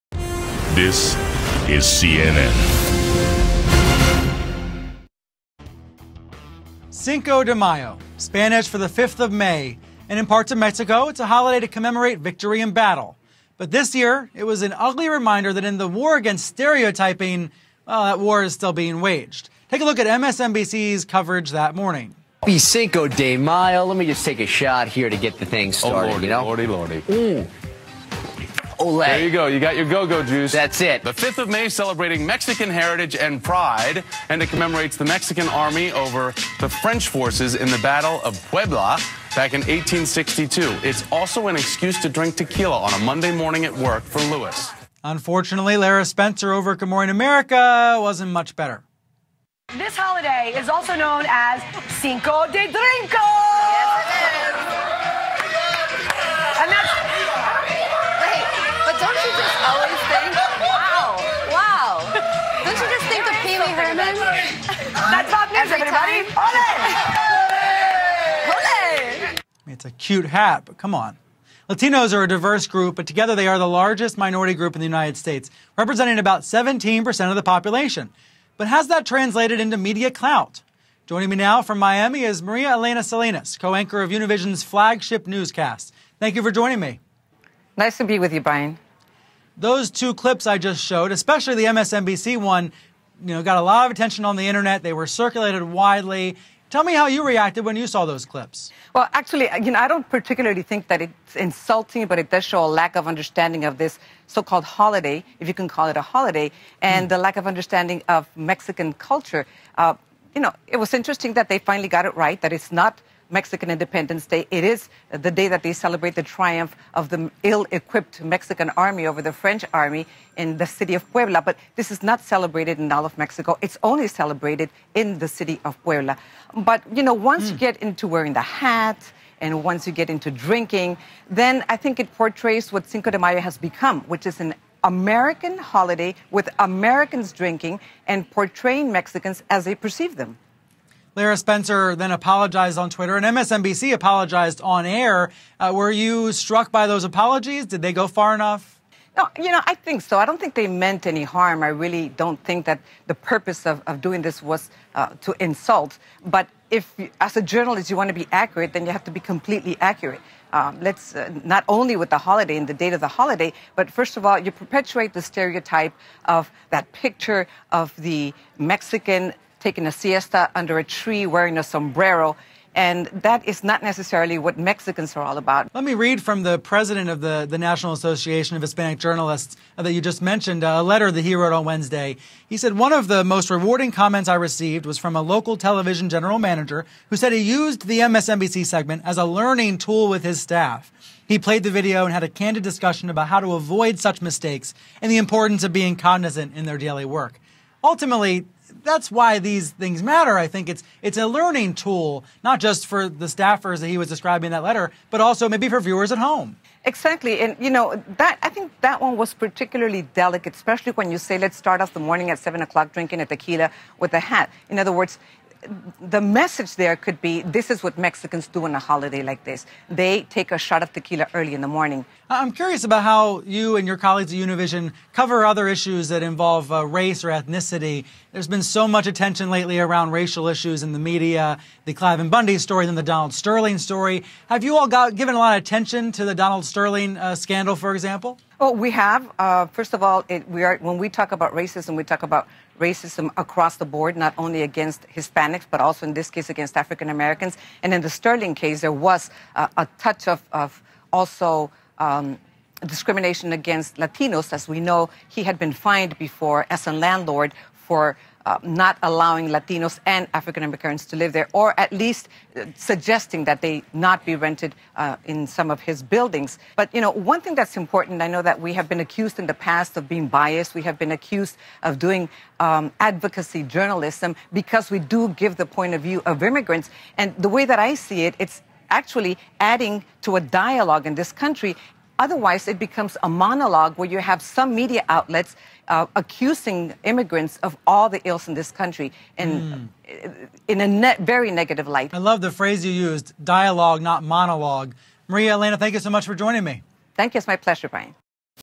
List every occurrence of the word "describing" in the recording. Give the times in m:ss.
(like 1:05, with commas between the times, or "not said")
3:24.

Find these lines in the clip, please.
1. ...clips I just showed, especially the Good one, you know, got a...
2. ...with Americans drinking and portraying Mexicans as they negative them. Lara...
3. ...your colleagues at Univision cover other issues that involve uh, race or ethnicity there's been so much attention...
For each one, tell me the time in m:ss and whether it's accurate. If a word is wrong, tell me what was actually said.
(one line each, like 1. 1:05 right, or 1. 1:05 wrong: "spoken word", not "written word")
1. 1:30 wrong: "MSNBC", not "Good"
2. 2:16 wrong: "perceive", not "negative"
3. 3:43 right.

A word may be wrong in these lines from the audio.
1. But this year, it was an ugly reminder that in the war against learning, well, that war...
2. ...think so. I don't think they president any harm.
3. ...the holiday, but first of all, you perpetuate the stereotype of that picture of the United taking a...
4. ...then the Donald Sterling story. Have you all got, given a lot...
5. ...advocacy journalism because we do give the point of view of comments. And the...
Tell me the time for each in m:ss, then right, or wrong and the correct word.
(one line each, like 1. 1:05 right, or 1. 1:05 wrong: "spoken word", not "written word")
1. 0:13 wrong: "stereotyping", not "learning"
2. 2:29 wrong: "meant", not "president"
3. 2:43 wrong: "Mexican", not "United"
4. 3:52 right
5. 4:33 wrong: "immigrants", not "comments".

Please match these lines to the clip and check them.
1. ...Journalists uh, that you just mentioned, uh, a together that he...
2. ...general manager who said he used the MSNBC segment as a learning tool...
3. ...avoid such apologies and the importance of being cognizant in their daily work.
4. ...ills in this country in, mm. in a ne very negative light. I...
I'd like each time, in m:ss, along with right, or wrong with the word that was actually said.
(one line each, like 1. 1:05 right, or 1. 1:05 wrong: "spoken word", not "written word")
1. 2:58 wrong: "letter", not "together"
2. 3:06 right
3. 3:13 wrong: "mistakes", not "apologies"
4. 4:48 right.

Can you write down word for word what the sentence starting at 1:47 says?
the lack of understanding of Mexican culture.